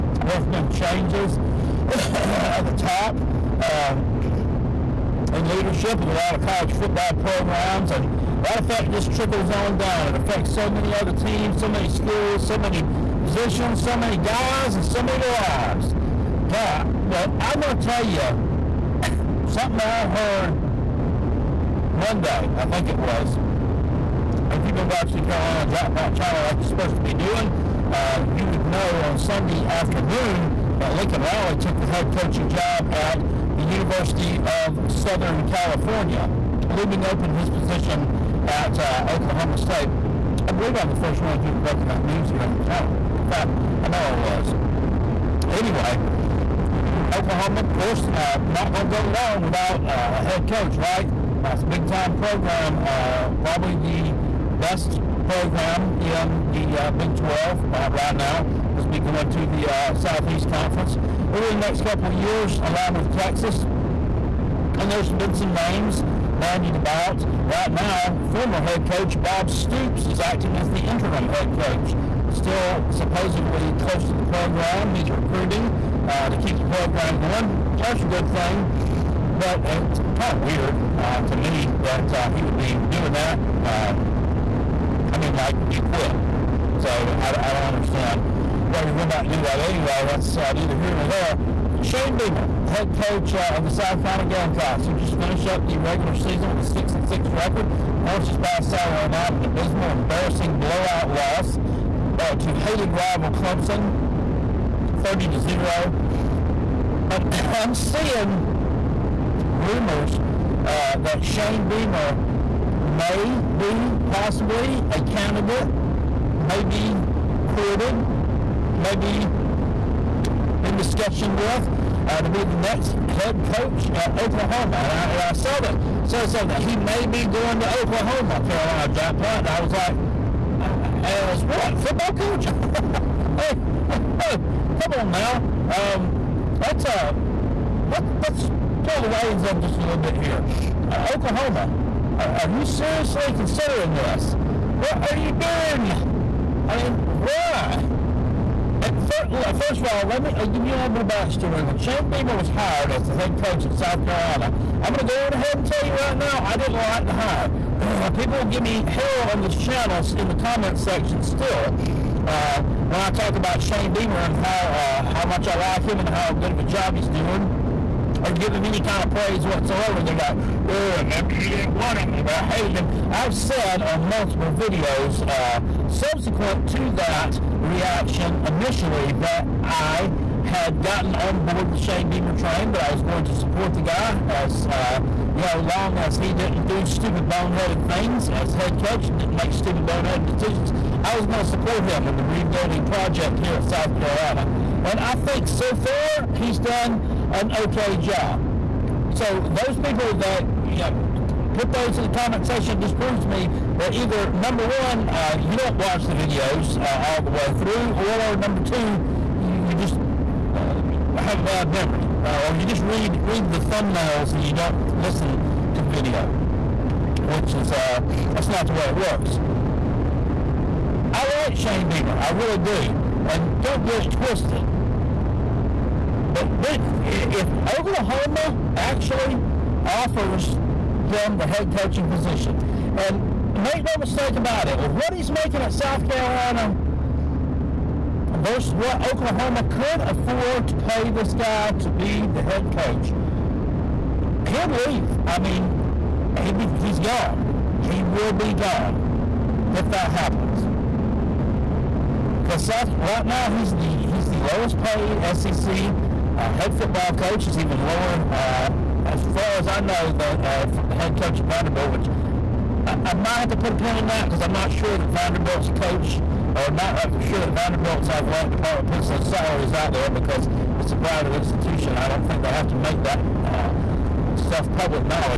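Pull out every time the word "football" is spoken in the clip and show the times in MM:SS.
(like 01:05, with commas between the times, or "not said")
00:06, 02:11, 04:16.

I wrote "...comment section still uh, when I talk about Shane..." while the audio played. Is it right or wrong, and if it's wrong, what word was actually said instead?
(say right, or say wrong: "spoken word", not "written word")
right.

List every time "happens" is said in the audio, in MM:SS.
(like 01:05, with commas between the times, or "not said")
04:10.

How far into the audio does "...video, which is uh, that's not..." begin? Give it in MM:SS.
03:35.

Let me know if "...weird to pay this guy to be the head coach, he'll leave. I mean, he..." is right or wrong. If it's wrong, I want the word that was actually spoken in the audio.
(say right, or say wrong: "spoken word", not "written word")
wrong: "afford", not "weird".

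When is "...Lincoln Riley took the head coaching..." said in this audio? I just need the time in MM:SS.
00:30.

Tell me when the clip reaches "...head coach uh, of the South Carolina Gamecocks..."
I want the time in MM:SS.
01:32.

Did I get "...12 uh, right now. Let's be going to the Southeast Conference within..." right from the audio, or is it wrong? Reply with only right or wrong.
right.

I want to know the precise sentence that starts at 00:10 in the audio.
It affects so many other teams, so many schools, so many positions, so many guys, and so many lives.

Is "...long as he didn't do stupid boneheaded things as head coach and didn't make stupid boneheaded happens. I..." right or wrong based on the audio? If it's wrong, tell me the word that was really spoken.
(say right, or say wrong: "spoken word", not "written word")
wrong: "decisions", not "happens".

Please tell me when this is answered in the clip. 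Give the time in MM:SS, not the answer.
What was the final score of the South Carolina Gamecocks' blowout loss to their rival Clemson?
01:45.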